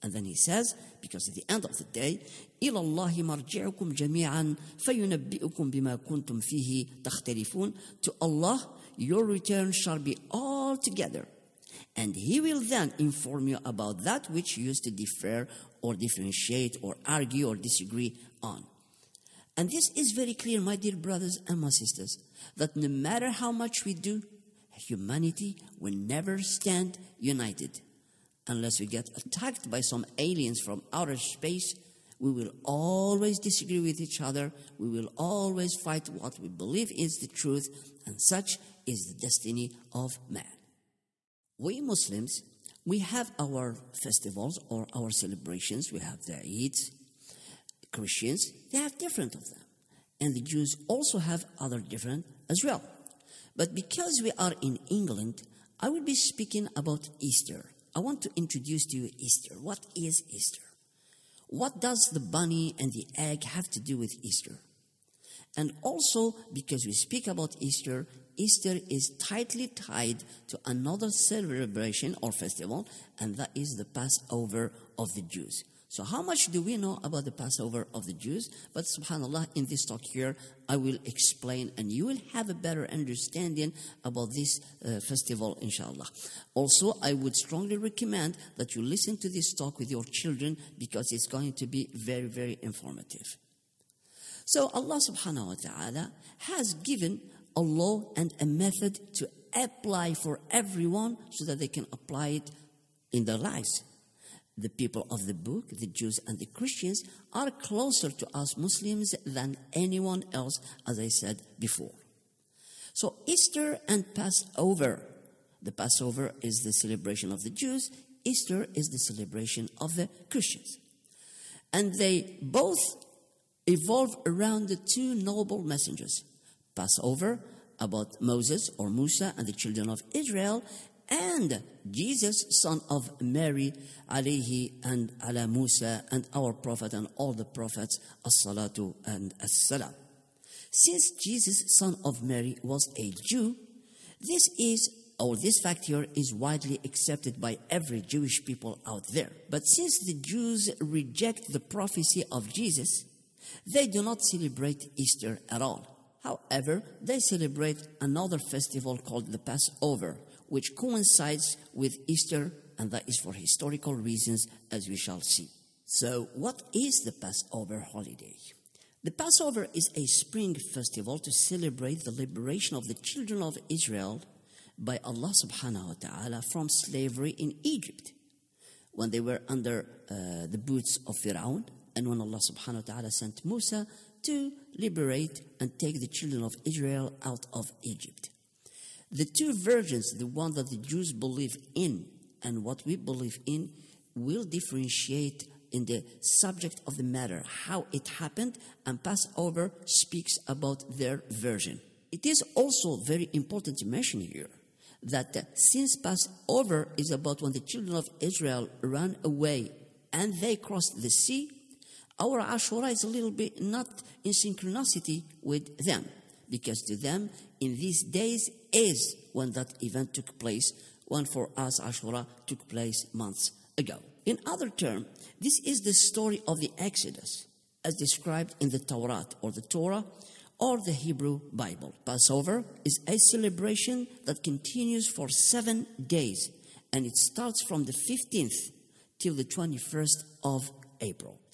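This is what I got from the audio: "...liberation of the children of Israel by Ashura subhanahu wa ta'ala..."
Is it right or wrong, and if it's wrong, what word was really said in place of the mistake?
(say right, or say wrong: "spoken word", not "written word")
wrong: "Allah", not "Ashura".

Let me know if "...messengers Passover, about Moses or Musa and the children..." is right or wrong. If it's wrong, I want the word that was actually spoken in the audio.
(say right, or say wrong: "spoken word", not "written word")
right.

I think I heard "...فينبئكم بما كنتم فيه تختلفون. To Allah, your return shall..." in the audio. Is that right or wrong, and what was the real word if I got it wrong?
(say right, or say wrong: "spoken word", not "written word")
right.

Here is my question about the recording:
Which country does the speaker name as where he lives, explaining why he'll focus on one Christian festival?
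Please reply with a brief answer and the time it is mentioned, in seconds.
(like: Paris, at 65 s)
England, at 54 s.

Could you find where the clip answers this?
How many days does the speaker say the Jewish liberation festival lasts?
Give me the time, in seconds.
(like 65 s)
235 s.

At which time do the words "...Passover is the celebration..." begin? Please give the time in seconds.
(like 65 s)
115 s.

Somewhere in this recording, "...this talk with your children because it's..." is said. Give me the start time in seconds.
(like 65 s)
89 s.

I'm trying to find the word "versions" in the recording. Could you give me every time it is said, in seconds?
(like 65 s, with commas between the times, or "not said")
189 s, 201 s.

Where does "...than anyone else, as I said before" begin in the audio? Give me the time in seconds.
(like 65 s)
109 s.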